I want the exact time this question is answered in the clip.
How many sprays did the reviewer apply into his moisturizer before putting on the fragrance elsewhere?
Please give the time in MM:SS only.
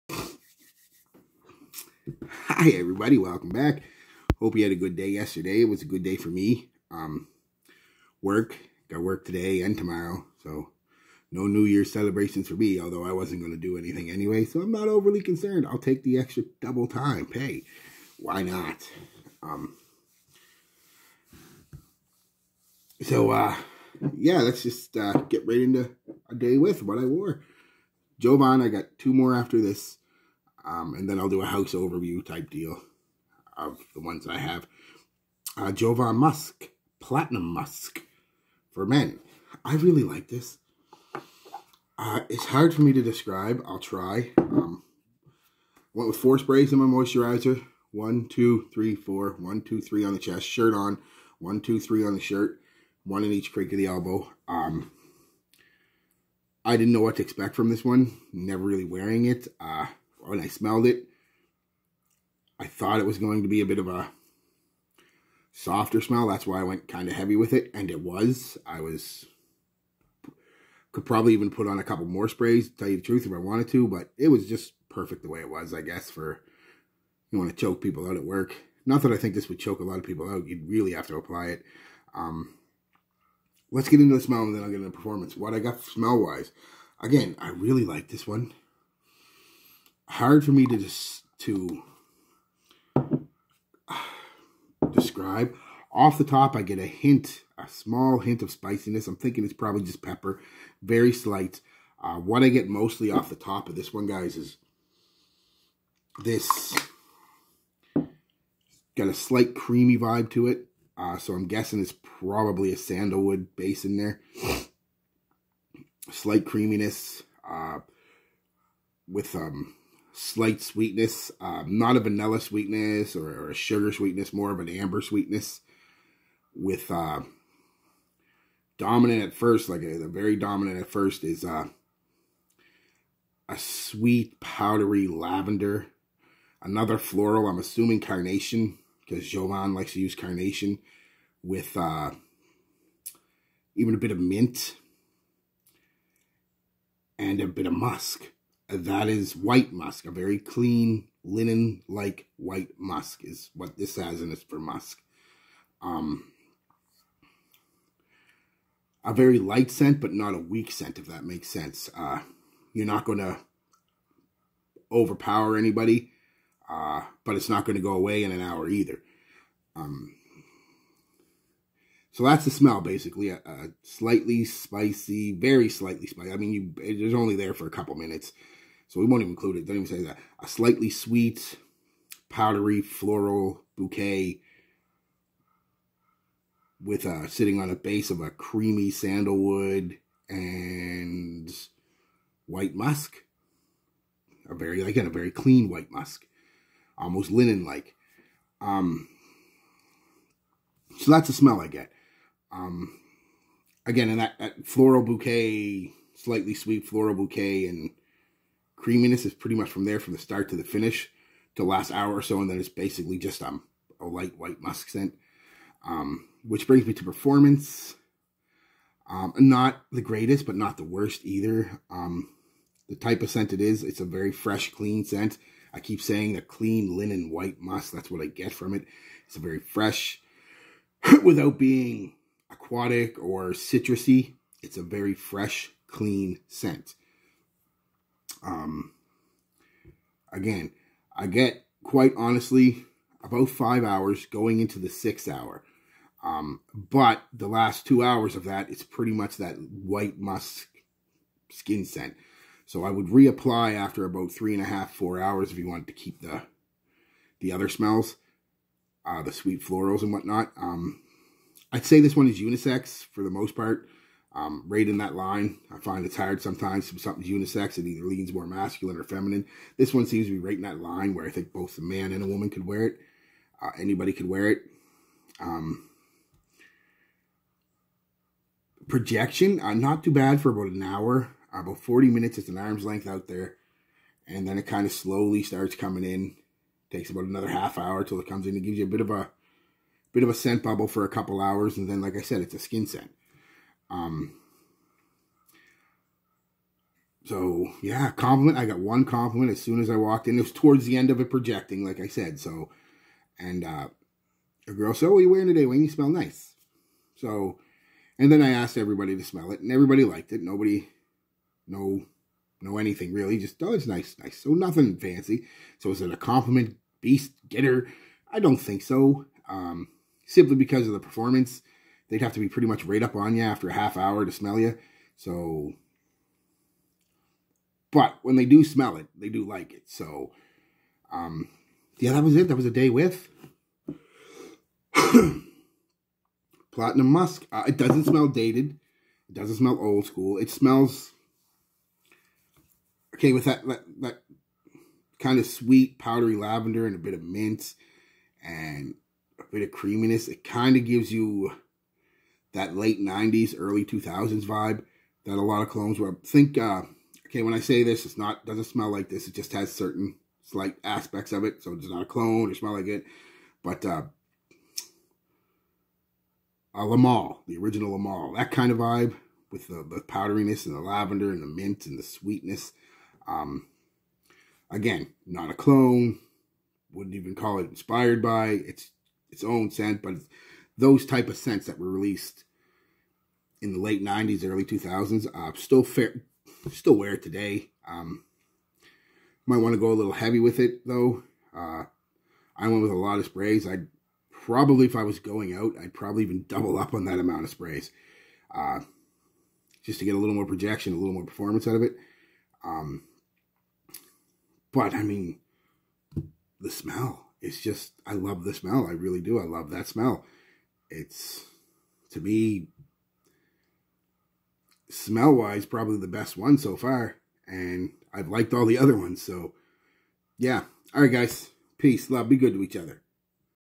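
00:46.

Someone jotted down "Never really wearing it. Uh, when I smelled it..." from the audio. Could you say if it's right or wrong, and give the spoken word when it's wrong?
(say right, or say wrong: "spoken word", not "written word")
right.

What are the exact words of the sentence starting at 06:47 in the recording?
It's just, I love the smell.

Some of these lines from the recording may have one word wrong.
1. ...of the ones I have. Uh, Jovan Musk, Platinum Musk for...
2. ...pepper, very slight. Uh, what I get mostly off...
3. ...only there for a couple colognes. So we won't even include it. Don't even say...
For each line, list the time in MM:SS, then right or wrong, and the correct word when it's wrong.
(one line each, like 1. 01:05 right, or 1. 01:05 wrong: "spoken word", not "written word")
1. 00:33 right
2. 01:40 right
3. 02:57 wrong: "minutes", not "colognes".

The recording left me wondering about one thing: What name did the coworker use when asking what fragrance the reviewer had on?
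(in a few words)
Wayne.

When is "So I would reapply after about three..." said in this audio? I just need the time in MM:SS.
04:12.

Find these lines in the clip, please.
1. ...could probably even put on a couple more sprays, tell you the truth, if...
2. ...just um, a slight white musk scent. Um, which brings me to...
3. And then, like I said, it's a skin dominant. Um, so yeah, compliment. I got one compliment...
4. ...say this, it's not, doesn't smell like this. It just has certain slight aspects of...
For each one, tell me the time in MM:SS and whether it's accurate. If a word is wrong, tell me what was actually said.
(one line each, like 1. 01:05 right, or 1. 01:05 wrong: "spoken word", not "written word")
1. 01:10 right
2. 03:33 wrong: "light", not "slight"
3. 04:51 wrong: "scent", not "dominant"
4. 05:57 right.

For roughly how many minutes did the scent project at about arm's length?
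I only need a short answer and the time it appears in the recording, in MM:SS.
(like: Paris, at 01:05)
40, at 04:41.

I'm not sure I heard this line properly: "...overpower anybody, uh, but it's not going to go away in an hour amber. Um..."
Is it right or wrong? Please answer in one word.
wrong.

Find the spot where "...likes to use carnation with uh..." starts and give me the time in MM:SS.
02:19.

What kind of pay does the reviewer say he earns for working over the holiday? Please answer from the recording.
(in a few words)
double time.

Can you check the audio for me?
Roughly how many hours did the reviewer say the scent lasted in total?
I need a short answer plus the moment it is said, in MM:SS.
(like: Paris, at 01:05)
5, at 04:03.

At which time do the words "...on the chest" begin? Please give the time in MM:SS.
00:50.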